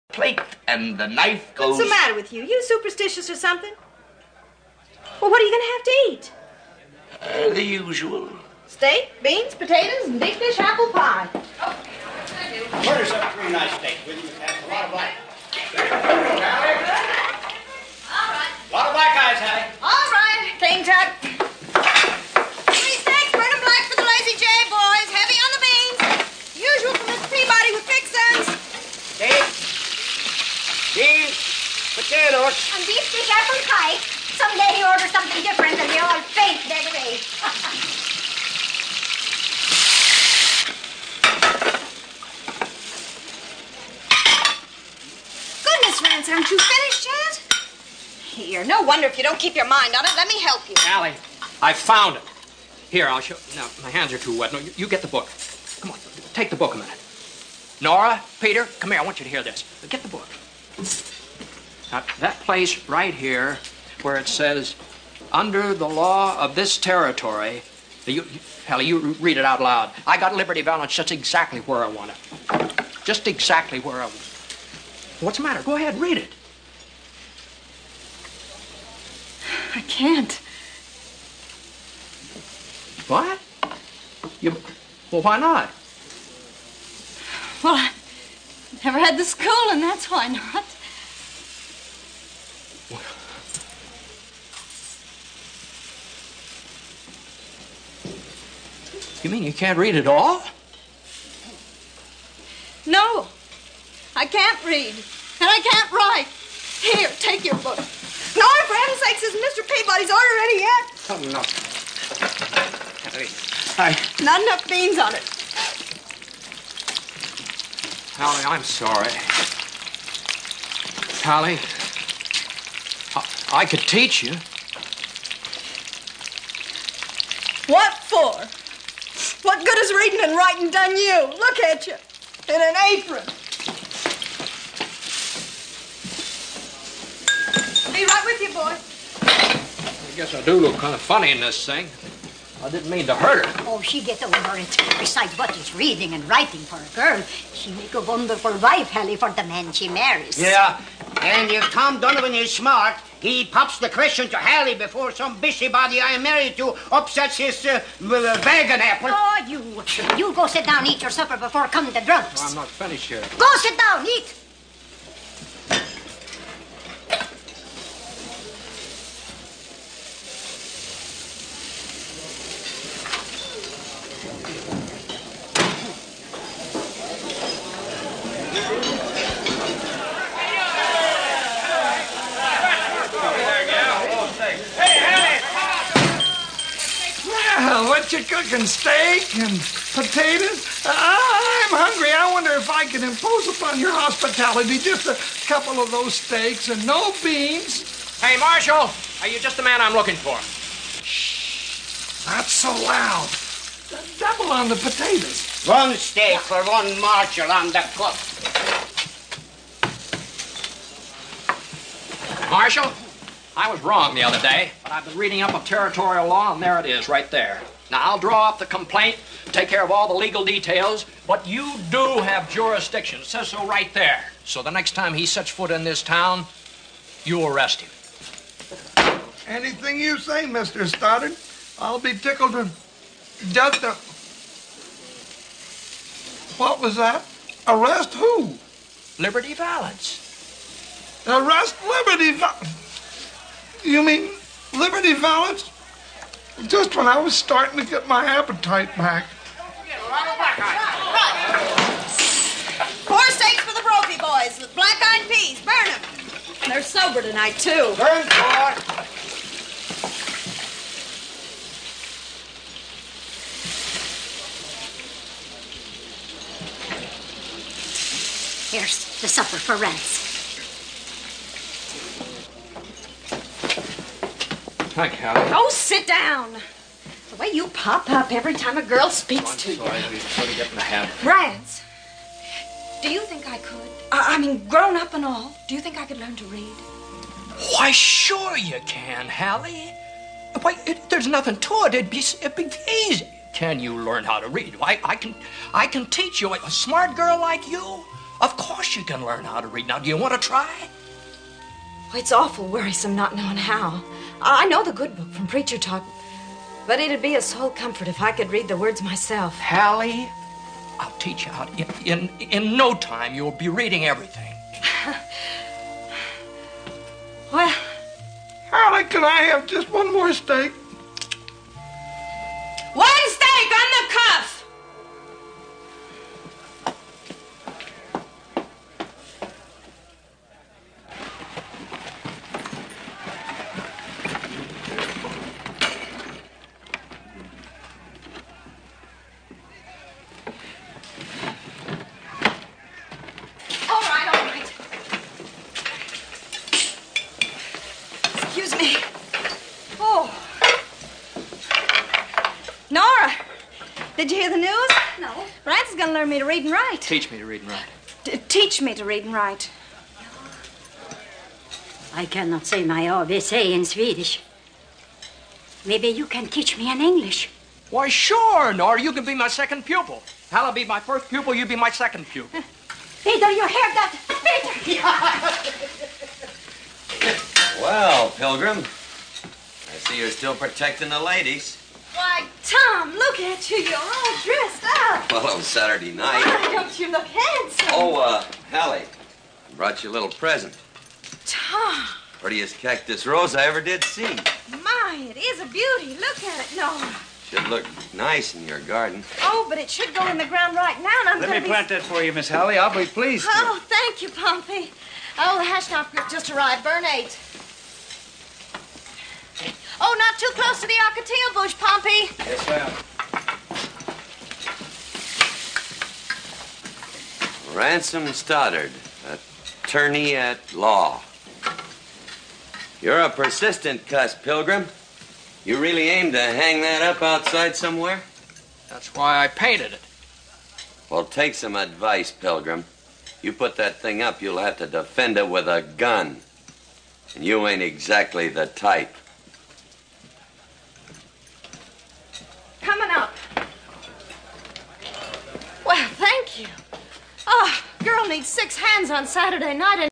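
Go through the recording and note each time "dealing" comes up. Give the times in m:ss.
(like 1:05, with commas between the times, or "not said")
not said.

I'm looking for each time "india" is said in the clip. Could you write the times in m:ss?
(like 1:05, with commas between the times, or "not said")
not said.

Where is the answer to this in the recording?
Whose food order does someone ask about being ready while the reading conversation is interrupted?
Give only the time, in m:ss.
1:49.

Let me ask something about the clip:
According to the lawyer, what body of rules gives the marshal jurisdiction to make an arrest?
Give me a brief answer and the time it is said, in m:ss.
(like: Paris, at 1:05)
The law of this territory, at 1:05.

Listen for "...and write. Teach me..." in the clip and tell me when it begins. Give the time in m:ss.
5:56.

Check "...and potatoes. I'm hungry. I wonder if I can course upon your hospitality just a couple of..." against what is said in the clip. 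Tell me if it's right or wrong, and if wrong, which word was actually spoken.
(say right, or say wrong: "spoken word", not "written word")
wrong: "impose", not "course".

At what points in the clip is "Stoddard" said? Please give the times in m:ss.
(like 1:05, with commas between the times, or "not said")
3:50, 6:58.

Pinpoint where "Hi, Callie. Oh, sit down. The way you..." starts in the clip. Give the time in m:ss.
4:34.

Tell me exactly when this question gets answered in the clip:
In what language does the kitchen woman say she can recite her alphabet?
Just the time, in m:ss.
6:03.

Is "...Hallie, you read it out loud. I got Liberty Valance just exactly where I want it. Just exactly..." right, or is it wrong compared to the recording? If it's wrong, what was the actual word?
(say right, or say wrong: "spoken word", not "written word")
right.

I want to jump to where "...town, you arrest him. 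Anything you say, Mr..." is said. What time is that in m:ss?
3:46.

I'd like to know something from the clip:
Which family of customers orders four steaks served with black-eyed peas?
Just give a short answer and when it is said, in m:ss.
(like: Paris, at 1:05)
The Brophy boys, at 4:13.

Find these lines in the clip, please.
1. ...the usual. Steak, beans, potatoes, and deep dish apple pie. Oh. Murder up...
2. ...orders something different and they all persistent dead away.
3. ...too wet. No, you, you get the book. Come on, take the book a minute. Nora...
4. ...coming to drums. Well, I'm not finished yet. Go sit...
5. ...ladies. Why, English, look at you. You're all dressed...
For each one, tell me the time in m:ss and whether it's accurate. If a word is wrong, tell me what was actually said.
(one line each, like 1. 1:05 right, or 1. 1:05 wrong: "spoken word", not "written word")
1. 0:07 right
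2. 0:34 wrong: "faint", not "persistent"
3. 0:54 right
4. 2:41 right
5. 6:21 wrong: "Tom", not "English".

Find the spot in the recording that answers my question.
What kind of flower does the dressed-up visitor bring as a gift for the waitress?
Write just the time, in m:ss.
6:32.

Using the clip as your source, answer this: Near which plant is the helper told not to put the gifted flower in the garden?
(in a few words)
Ocotillo bush.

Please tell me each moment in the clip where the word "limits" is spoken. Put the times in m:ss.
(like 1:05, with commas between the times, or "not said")
not said.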